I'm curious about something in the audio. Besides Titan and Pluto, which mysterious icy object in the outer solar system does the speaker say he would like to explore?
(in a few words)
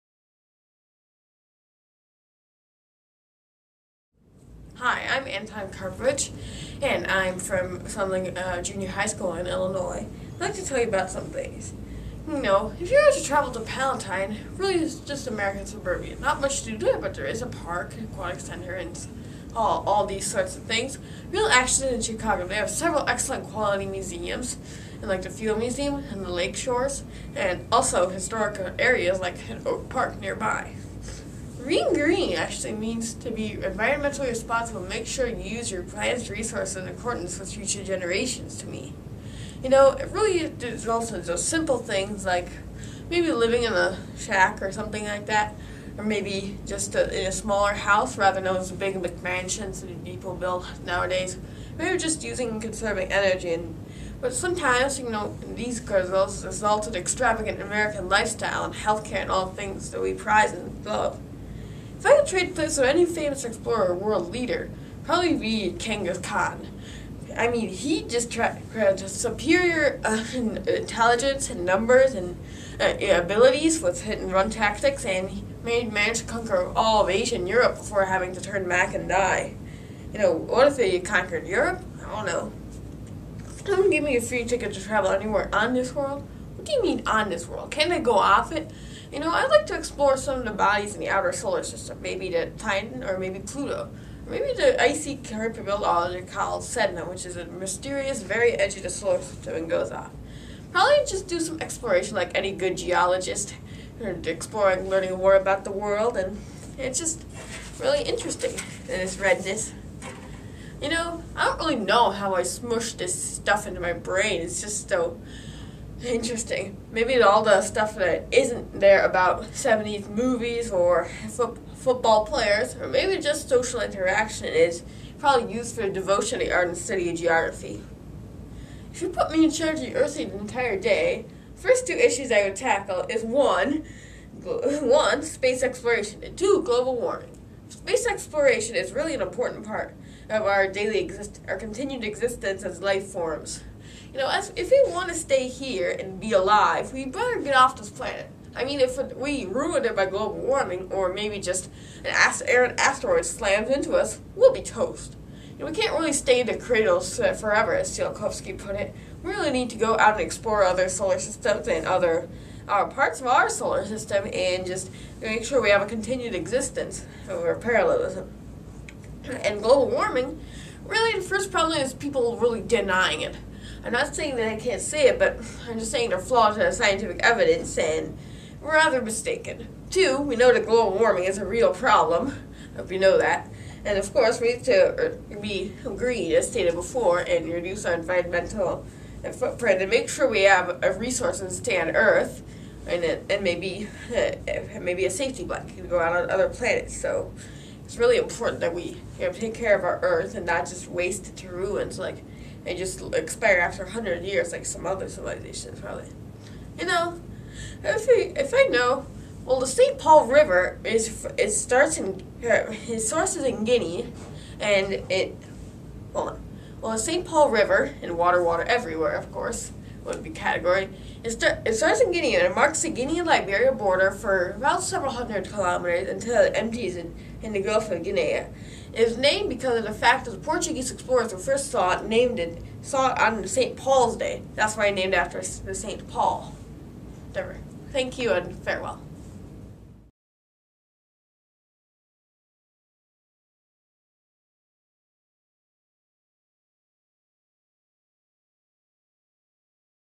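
Sedna.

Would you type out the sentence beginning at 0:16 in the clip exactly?
Not much to do, but there is a park, an aquatic center, and all, all these sorts of things.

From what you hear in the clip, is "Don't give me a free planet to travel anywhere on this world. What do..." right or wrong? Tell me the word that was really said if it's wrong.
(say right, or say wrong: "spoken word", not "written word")
wrong: "ticket", not "planet".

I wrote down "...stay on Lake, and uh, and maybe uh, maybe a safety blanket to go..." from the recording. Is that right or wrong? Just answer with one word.
wrong.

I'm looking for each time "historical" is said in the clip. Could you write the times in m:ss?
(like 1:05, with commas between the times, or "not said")
0:28.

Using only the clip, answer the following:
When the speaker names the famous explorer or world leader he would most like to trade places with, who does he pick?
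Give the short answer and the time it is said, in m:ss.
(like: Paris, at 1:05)
Genghis Khan, at 1:05.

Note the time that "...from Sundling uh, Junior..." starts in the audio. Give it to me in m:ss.
0:07.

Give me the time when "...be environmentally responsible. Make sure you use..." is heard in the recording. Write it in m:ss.
0:33.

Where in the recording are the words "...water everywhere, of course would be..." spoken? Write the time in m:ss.
3:38.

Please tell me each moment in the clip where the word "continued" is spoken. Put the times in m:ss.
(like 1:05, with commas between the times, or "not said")
2:21, 2:45.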